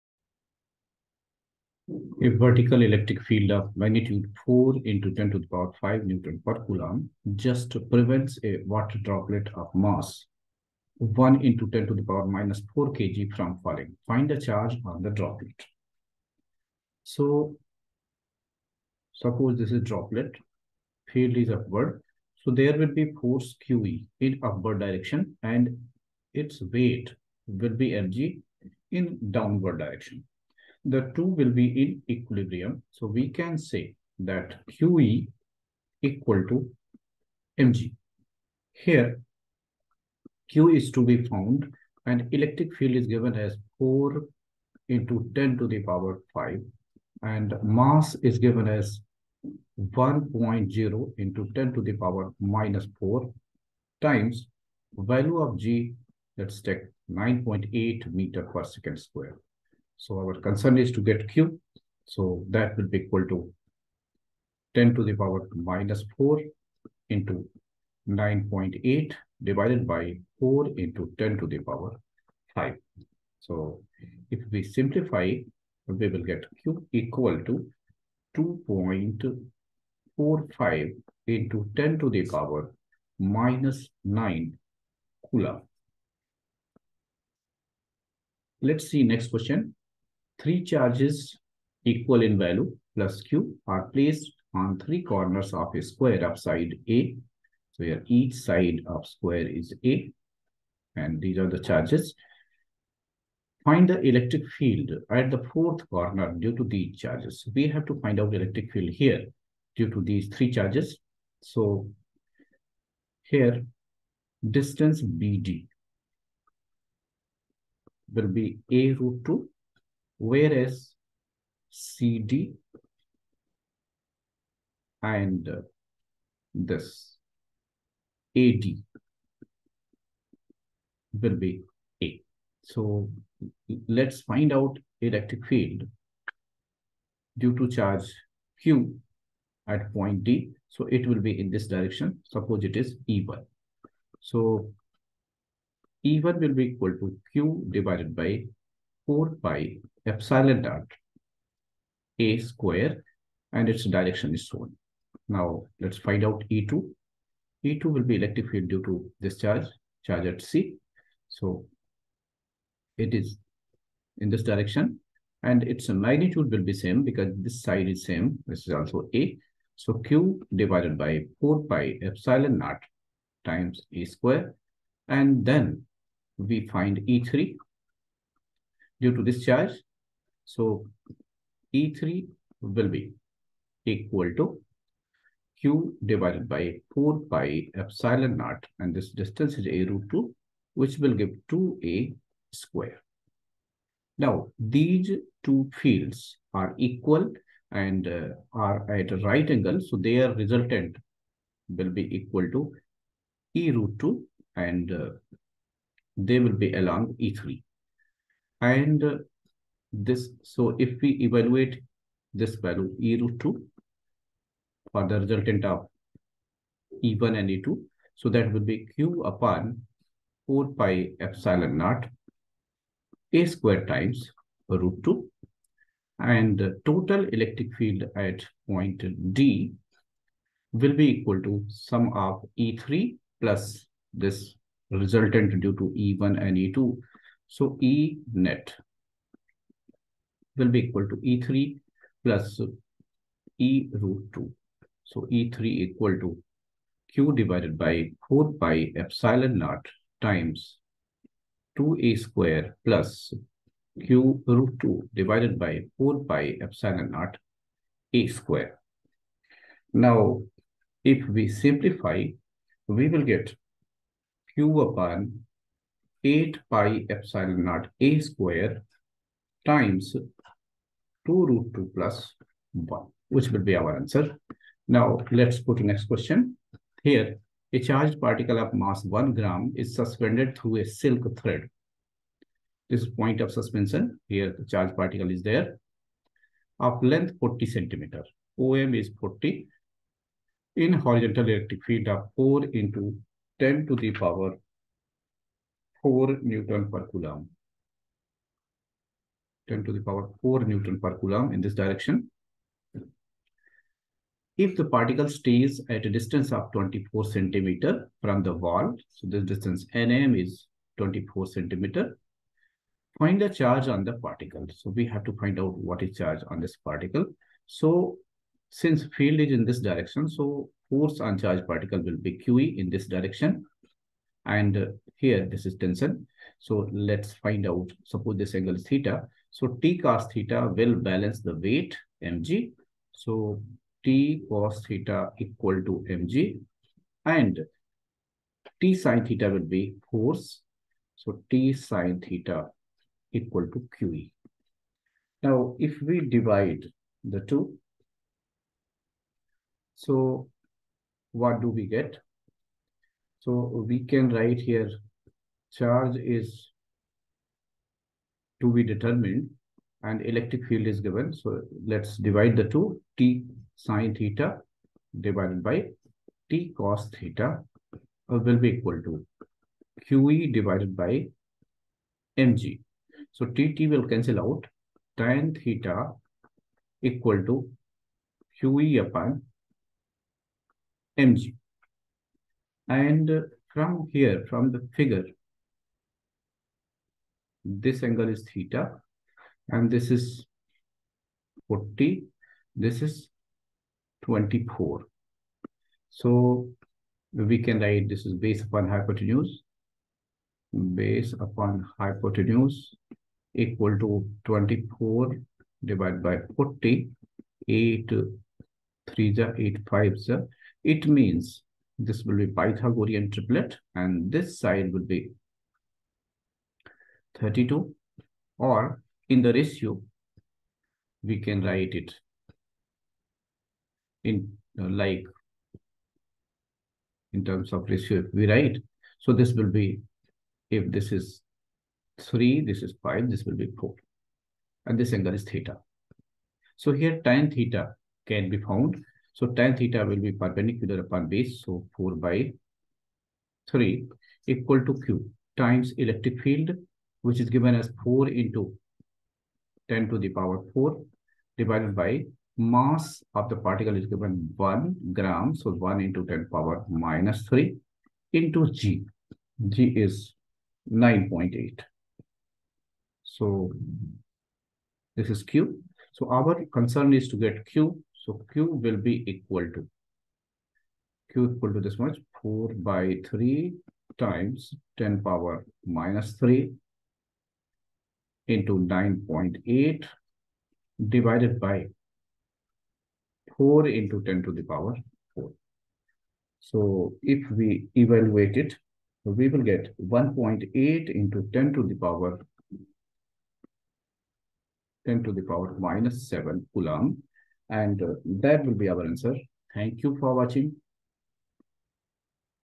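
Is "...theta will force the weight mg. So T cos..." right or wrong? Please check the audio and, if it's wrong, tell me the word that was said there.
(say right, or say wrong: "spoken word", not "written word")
wrong: "balance", not "force".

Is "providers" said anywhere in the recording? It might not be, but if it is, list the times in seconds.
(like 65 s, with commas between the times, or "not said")
not said.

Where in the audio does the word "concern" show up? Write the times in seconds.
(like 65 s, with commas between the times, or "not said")
60 s, 466 s.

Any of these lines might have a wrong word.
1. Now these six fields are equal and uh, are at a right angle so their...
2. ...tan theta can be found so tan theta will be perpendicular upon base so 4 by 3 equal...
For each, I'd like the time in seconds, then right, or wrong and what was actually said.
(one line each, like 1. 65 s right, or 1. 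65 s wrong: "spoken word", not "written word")
1. 194 s wrong: "two", not "six"
2. 437 s right.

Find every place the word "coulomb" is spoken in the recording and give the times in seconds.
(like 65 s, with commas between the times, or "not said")
6 s, 85 s, 297 s, 301 s, 496 s.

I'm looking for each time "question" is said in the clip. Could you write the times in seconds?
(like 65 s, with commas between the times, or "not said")
89 s, 276 s.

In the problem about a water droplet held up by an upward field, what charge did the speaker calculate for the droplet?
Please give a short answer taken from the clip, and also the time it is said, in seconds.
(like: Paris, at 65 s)
2.45 × 10^-9 C, at 78 s.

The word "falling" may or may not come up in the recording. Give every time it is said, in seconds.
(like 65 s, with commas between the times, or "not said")
13 s.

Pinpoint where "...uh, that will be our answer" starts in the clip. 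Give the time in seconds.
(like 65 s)
498 s.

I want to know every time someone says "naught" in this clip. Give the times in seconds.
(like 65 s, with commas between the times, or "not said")
150 s, 172 s, 188 s, 221 s, 249 s, 257 s, 267 s.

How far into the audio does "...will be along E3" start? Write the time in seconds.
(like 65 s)
206 s.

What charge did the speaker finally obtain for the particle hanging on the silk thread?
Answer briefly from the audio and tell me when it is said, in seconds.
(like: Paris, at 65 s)
1.8 × 10^-7 C, at 489 s.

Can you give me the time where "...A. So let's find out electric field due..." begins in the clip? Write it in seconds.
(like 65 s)
132 s.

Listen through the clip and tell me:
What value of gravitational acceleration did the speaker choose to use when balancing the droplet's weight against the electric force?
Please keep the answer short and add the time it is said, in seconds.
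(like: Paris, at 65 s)
9.8 m/s², at 57 s.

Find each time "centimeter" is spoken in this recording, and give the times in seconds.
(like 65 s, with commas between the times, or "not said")
287 s, 307 s, 311 s.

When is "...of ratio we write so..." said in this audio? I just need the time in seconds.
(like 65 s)
427 s.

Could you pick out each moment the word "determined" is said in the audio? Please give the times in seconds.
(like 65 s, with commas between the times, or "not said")
358 s.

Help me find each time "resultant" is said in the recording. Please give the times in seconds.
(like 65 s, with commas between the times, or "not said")
200 s, 215 s, 234 s.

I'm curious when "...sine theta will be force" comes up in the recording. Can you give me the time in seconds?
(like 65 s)
338 s.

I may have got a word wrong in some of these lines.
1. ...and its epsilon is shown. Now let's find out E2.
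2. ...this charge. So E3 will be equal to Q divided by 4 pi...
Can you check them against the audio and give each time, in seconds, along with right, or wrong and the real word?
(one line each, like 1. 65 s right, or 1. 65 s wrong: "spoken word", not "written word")
1. 153 s wrong: "direction", not "epsilon"
2. 179 s right.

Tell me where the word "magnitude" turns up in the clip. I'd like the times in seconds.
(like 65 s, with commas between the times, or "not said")
3 s, 166 s.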